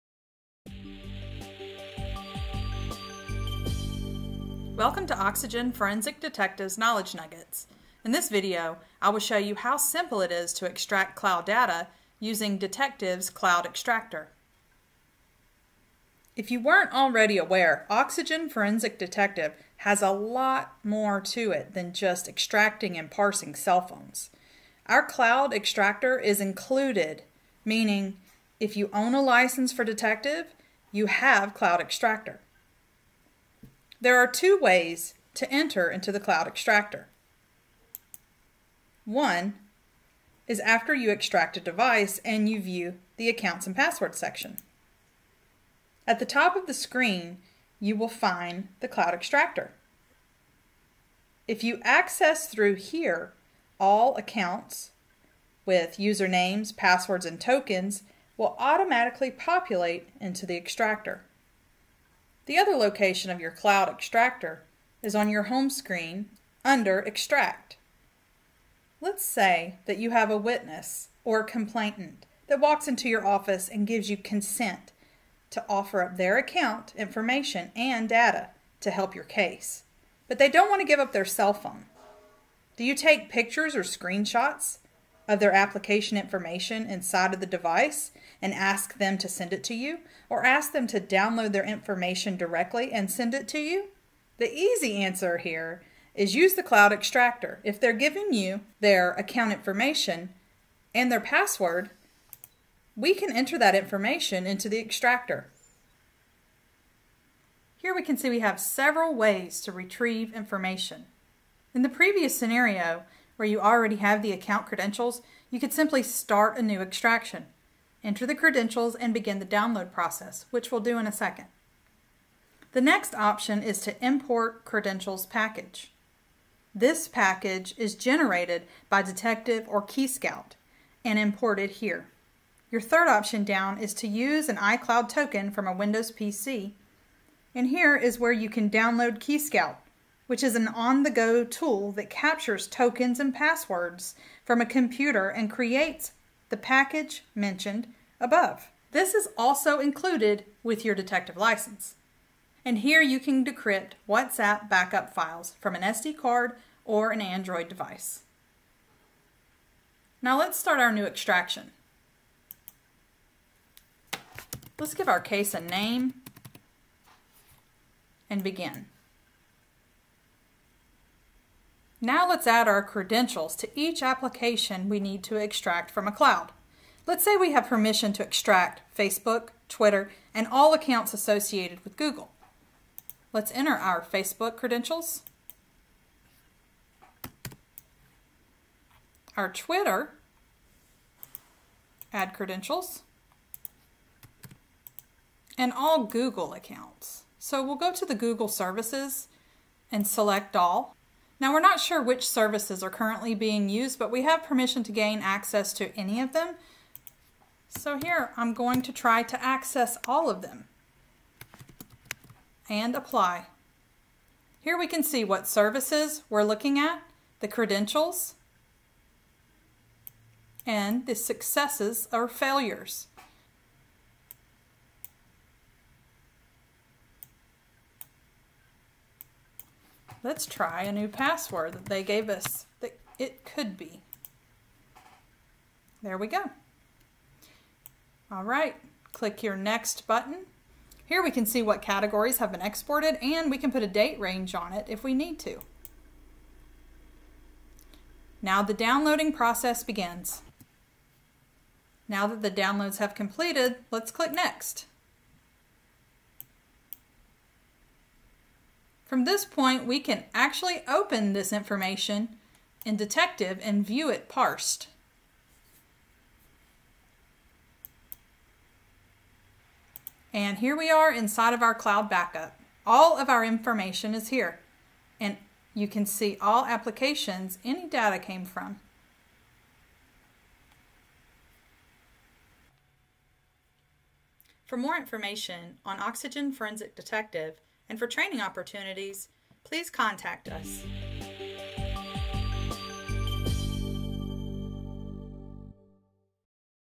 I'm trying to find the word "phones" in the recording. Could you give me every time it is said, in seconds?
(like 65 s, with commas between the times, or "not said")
23 s, 81 s.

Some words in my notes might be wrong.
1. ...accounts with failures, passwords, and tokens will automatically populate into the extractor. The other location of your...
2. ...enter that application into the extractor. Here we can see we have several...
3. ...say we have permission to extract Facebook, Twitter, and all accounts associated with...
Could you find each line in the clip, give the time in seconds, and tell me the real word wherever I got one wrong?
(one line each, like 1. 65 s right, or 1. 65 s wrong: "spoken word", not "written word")
1. 54 s wrong: "usernames", not "failures"
2. 103 s wrong: "information", not "application"
3. 177 s right.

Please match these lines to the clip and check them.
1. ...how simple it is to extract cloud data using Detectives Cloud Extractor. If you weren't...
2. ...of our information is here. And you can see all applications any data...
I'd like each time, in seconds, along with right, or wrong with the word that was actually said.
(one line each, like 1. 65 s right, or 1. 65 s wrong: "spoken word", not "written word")
1. 9 s right
2. 273 s right.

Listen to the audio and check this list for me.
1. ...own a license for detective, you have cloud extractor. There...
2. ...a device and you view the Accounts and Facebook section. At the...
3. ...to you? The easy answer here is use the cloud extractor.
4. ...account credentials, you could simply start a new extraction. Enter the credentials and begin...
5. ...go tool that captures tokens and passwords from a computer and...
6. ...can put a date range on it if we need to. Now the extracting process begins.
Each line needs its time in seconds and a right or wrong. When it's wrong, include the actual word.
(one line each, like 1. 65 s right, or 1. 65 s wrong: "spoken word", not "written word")
1. 28 s right
2. 41 s wrong: "Passwords", not "Facebook"
3. 93 s right
4. 114 s right
5. 141 s right
6. 243 s wrong: "downloading", not "extracting".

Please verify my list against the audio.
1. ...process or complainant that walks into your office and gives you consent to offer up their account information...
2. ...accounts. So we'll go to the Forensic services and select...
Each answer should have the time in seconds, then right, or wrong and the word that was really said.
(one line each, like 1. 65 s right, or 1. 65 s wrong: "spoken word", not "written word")
1. 70 s wrong: "witness", not "process"
2. 196 s wrong: "Google", not "Forensic".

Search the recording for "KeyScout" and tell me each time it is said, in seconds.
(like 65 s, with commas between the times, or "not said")
129 s, 139 s.